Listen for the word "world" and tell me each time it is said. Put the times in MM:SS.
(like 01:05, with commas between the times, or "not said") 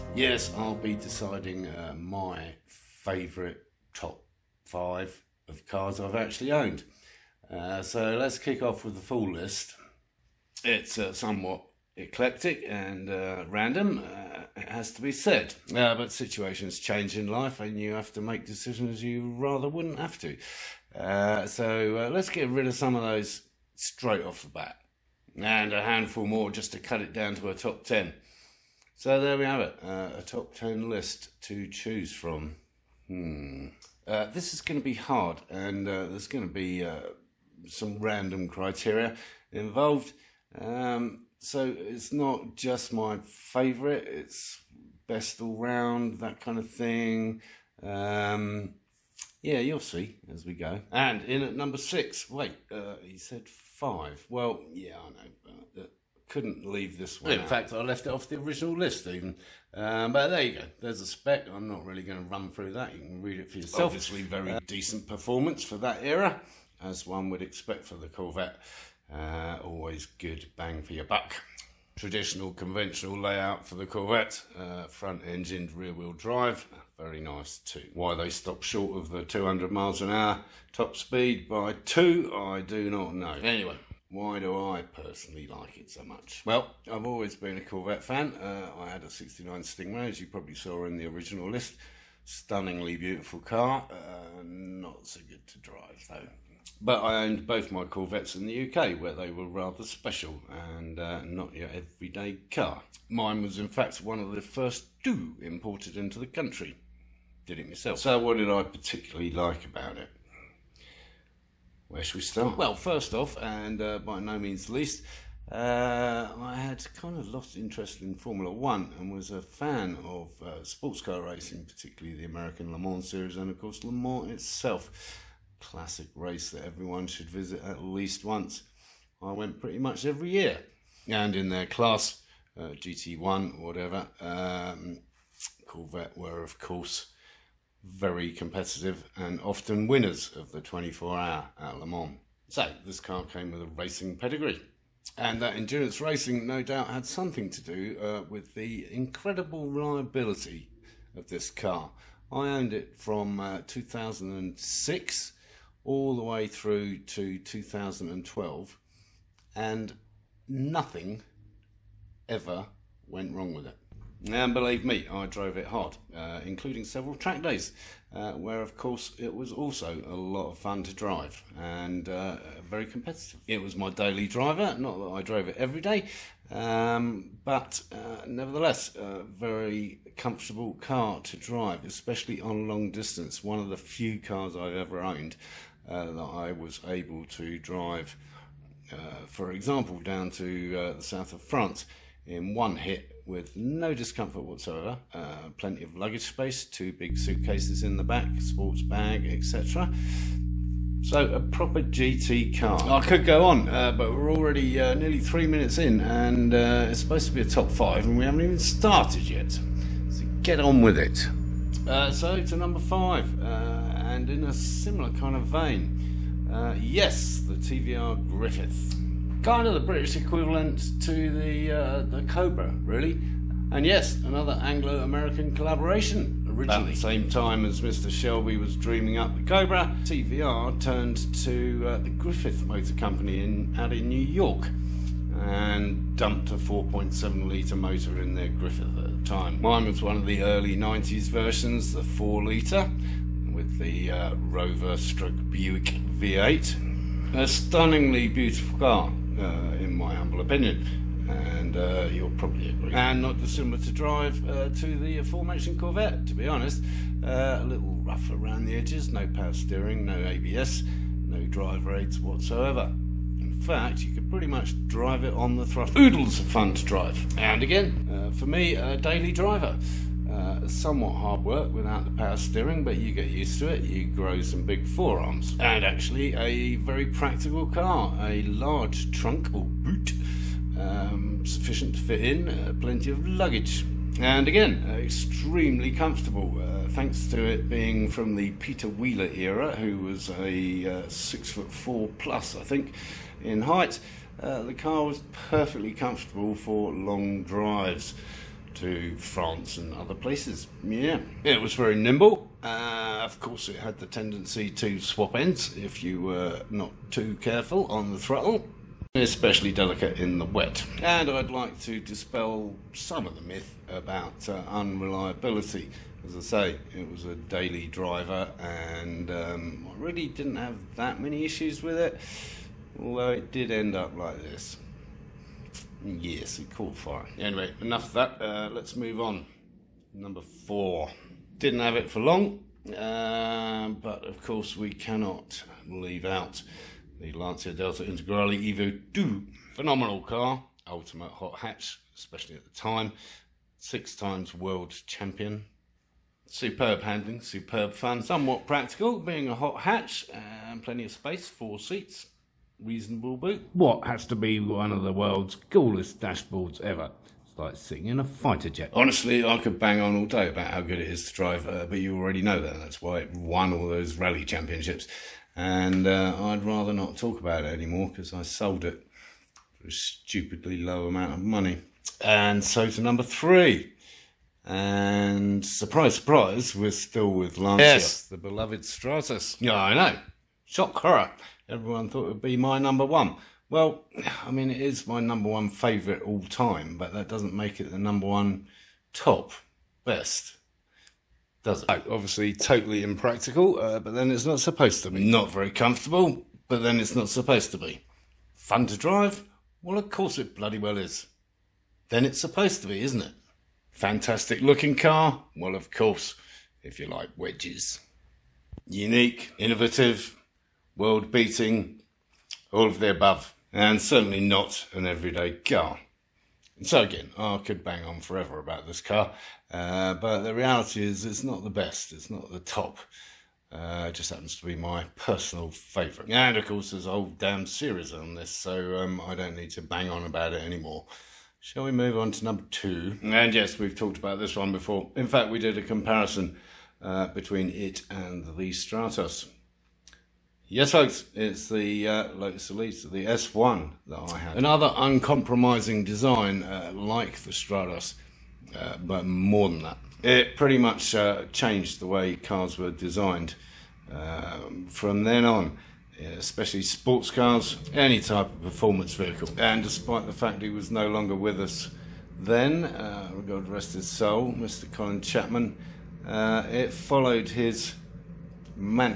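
05:44, 05:55, 06:50.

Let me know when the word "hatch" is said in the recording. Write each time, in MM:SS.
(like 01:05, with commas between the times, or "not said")
05:41, 05:49.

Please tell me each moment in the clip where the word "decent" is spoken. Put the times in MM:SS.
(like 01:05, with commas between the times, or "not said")
01:04.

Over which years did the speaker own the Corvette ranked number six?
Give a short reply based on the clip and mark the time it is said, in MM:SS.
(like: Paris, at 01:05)
2006 to 2012, at 02:33.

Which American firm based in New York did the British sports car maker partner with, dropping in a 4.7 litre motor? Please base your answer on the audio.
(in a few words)
Griffith Motor Company.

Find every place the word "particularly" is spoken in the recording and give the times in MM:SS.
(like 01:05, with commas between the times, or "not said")
01:48, 02:01.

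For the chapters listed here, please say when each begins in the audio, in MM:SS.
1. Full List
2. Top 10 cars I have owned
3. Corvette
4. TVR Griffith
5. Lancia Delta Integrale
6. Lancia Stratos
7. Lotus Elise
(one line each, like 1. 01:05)
1. 00:18
2. 00:38
3. 01:45
4. 03:36
5. 05:43
6. 06:55
7. 07:26.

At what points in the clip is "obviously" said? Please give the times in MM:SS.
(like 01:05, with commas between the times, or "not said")
01:03, 06:32.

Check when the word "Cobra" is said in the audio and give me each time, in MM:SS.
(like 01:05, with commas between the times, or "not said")
03:42, 03:49.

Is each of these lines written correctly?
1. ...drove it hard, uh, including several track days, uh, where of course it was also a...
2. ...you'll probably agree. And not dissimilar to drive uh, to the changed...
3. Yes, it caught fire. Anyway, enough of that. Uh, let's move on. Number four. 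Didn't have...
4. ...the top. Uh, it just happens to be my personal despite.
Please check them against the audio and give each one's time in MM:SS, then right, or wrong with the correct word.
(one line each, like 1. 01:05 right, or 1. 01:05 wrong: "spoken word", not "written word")
1. 02:45 right
2. 04:12 wrong: "aforementioned", not "changed"
3. 05:26 right
4. 07:02 wrong: "favourite", not "despite".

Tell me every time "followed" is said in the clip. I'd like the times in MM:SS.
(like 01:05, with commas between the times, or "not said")
07:46.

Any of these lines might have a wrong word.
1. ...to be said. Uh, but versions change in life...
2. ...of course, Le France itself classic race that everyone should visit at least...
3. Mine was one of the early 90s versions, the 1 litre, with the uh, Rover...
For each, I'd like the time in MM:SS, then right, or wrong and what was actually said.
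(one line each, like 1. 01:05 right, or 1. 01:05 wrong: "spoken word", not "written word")
1. 00:14 wrong: "situations", not "versions"
2. 02:03 wrong: "Mans", not "France"
3. 03:59 wrong: "4", not "1".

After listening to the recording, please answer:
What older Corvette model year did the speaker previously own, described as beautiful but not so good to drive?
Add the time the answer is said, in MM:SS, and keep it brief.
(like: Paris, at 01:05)
1969 Stingray, at 01:29.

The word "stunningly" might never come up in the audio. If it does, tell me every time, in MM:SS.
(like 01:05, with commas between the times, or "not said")
01:32, 04:07.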